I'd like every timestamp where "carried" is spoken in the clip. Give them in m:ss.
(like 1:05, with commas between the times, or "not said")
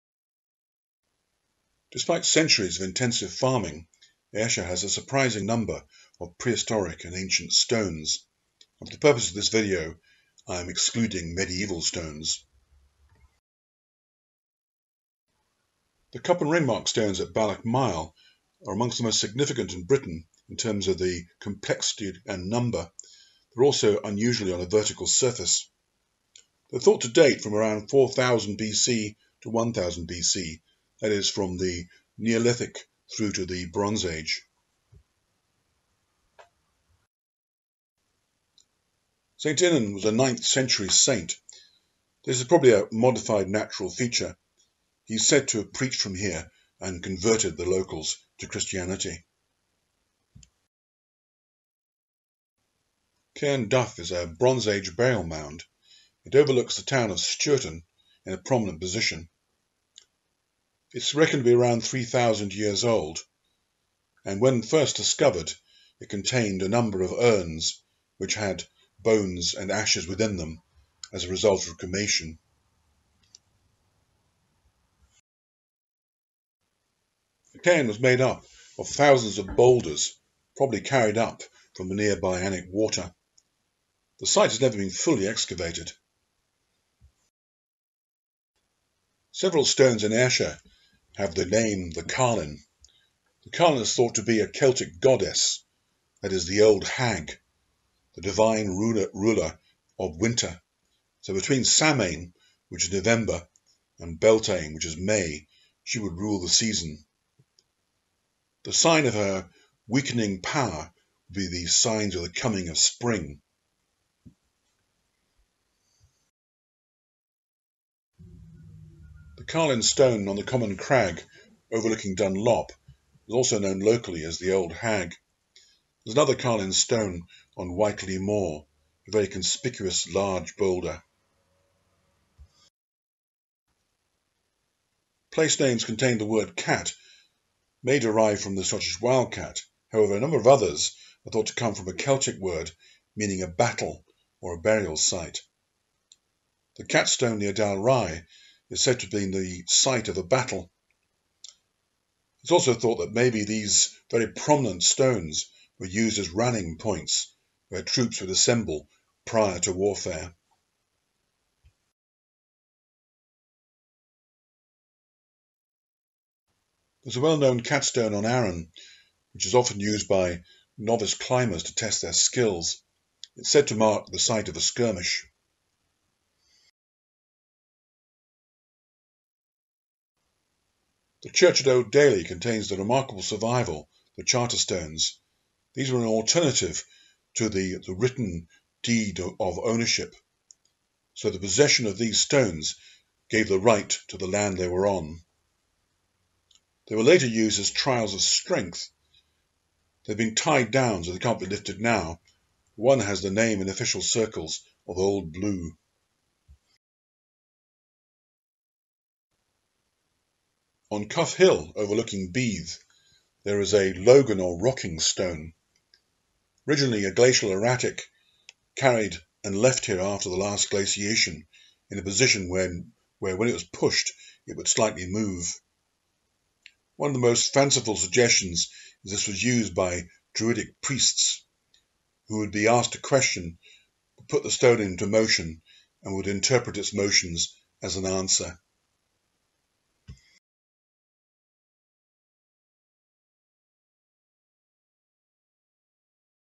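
1:20, 3:38.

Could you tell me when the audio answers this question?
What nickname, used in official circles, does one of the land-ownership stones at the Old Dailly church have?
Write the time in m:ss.
3:24.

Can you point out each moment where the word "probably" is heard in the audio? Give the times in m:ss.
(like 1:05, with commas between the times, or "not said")
0:42, 1:20.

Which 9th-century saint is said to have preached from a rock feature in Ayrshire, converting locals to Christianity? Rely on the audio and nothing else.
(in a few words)
St. Inan.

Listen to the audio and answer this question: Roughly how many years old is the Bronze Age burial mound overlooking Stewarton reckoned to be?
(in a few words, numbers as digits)
3,000.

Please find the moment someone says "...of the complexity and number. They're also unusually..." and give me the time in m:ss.
0:20.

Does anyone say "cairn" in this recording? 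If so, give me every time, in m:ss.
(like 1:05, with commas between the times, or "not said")
0:53, 1:17.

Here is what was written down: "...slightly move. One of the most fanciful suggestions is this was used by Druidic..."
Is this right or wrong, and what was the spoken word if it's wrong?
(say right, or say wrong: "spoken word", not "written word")
right.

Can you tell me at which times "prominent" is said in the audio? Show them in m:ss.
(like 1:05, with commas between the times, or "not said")
0:58, 2:34.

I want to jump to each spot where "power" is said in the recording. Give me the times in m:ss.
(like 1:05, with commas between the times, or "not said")
1:50.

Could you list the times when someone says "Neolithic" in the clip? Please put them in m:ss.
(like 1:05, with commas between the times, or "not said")
0:32.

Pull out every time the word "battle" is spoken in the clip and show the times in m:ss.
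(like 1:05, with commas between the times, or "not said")
2:23, 2:30.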